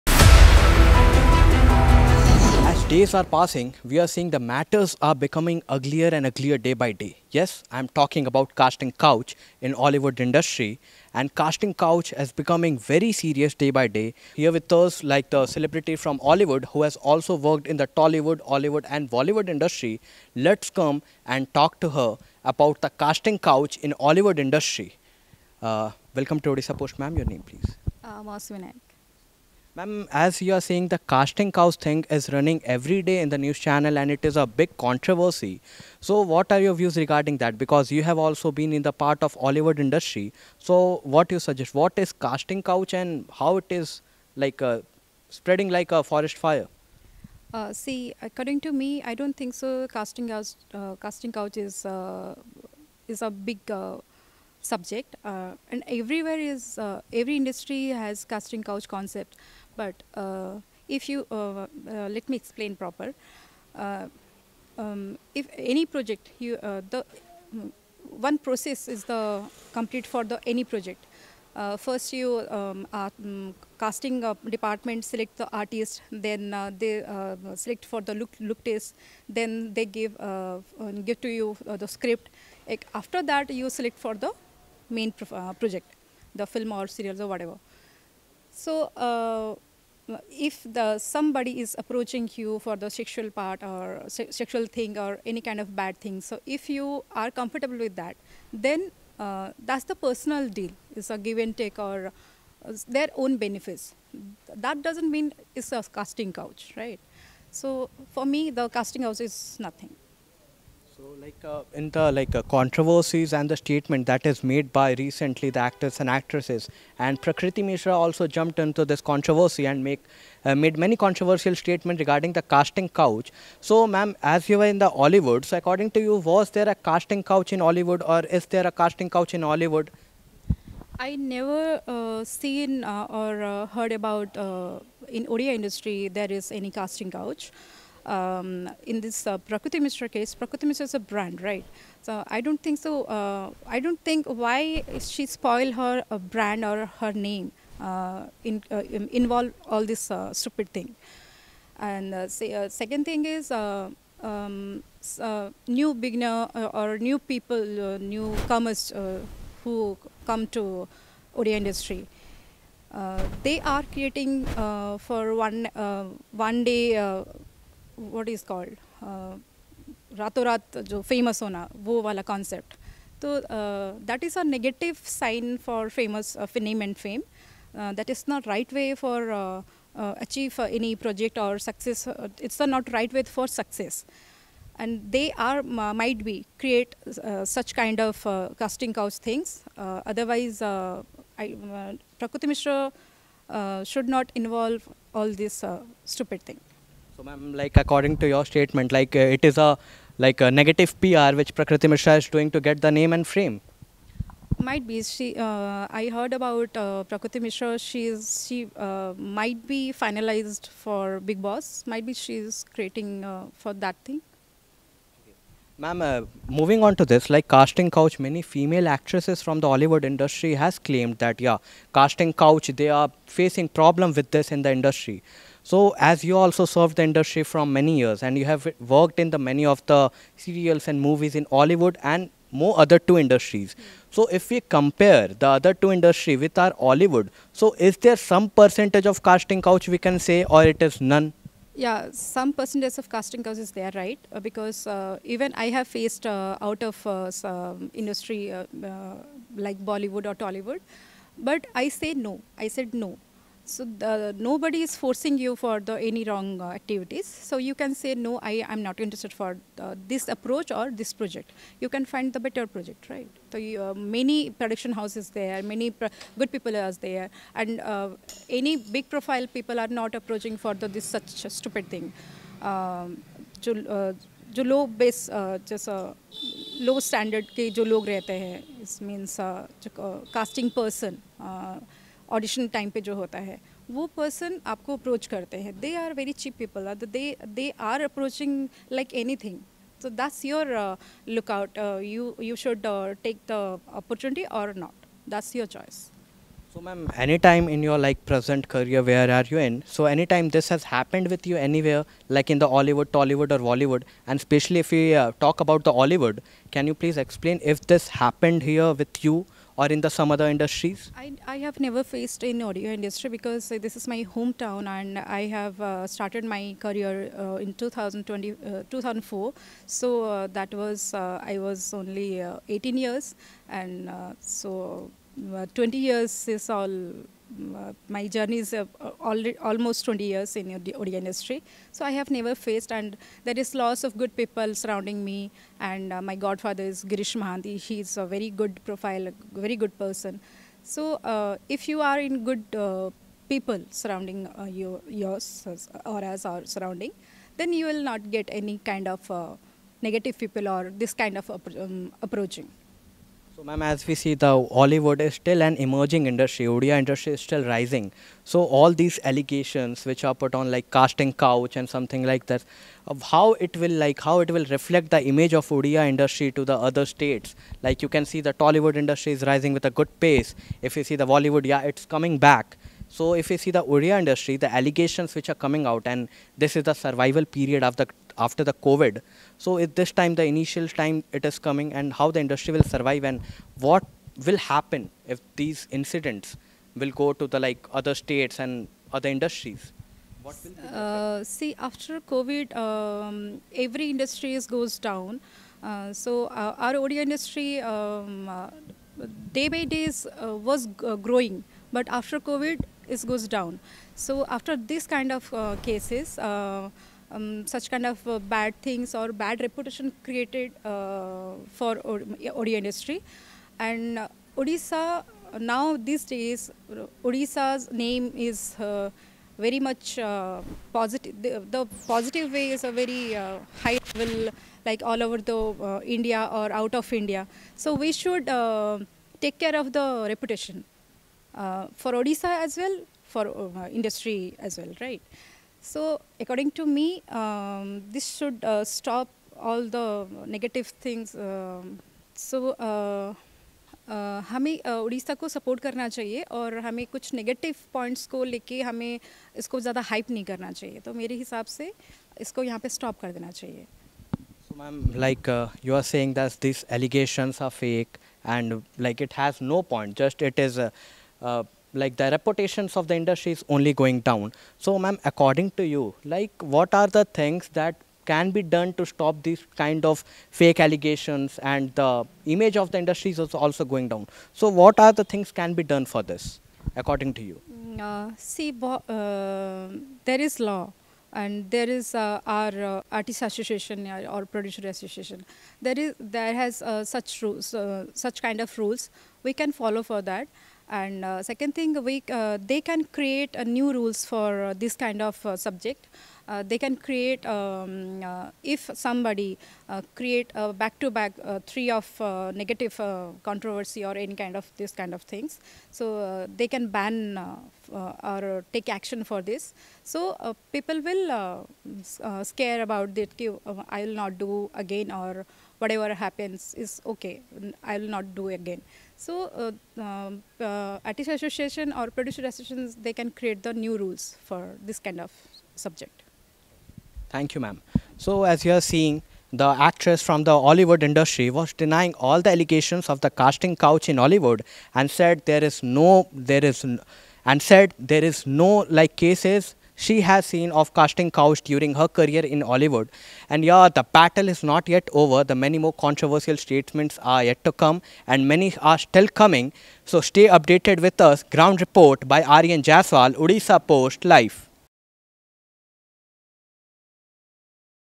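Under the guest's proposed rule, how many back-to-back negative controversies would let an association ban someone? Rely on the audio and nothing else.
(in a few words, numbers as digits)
3.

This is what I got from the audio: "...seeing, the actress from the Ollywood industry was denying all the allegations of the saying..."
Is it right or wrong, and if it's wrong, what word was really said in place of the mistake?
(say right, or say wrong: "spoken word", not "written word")
wrong: "casting", not "saying".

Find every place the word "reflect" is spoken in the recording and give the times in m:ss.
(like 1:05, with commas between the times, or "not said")
6:04.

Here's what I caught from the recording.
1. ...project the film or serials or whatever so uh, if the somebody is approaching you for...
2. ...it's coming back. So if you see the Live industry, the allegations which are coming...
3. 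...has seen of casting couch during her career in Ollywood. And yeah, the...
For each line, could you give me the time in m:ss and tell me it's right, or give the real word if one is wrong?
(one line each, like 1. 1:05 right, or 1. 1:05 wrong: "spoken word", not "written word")
1. 1:25 right
2. 6:11 wrong: "Odia", not "Live"
3. 9:00 right.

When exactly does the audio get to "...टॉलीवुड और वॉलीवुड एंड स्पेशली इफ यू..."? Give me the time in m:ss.
5:03.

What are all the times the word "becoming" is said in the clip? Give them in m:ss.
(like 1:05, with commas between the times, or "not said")
0:05, 0:12.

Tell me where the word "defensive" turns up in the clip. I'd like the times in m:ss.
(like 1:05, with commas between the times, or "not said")
not said.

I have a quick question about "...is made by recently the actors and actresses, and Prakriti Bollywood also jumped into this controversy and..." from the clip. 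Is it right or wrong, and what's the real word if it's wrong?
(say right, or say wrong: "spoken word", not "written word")
wrong: "Mishra", not "Bollywood".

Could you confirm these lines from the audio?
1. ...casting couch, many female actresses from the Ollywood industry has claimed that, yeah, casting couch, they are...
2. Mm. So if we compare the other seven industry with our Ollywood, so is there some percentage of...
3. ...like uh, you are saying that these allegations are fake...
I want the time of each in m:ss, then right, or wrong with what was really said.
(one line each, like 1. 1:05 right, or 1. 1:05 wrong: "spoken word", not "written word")
1. 3:37 right
2. 3:53 wrong: "two", not "seven"
3. 7:35 right.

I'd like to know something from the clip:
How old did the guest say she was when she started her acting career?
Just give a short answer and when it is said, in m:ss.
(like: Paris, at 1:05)
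18, at 5:22.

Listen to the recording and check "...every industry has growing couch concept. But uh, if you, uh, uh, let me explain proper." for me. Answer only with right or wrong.
wrong.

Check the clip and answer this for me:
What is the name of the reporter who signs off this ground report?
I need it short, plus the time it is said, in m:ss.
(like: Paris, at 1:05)
Aryan Jaswal, at 9:12.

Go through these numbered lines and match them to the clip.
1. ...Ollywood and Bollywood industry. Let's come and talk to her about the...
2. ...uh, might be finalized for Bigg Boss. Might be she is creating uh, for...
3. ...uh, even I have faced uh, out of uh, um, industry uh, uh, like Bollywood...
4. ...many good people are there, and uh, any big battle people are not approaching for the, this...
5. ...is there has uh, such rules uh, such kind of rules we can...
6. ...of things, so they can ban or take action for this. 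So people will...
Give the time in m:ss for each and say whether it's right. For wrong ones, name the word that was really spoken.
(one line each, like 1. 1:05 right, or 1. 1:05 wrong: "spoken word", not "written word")
1. 0:18 right
2. 3:28 right
3. 4:04 right
4. 4:25 wrong: "profile", not "battle"
5. 8:05 right
6. 8:25 right.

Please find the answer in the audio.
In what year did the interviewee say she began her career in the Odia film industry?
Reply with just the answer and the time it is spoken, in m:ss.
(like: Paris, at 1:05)
2004, at 5:18.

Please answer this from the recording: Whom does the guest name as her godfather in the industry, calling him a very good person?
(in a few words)
Girish Mahanti.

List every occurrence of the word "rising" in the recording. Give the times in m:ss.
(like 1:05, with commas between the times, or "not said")
5:57, 6:09.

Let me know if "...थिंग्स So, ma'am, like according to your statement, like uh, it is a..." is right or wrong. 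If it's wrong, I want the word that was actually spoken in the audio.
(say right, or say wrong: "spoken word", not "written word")
right.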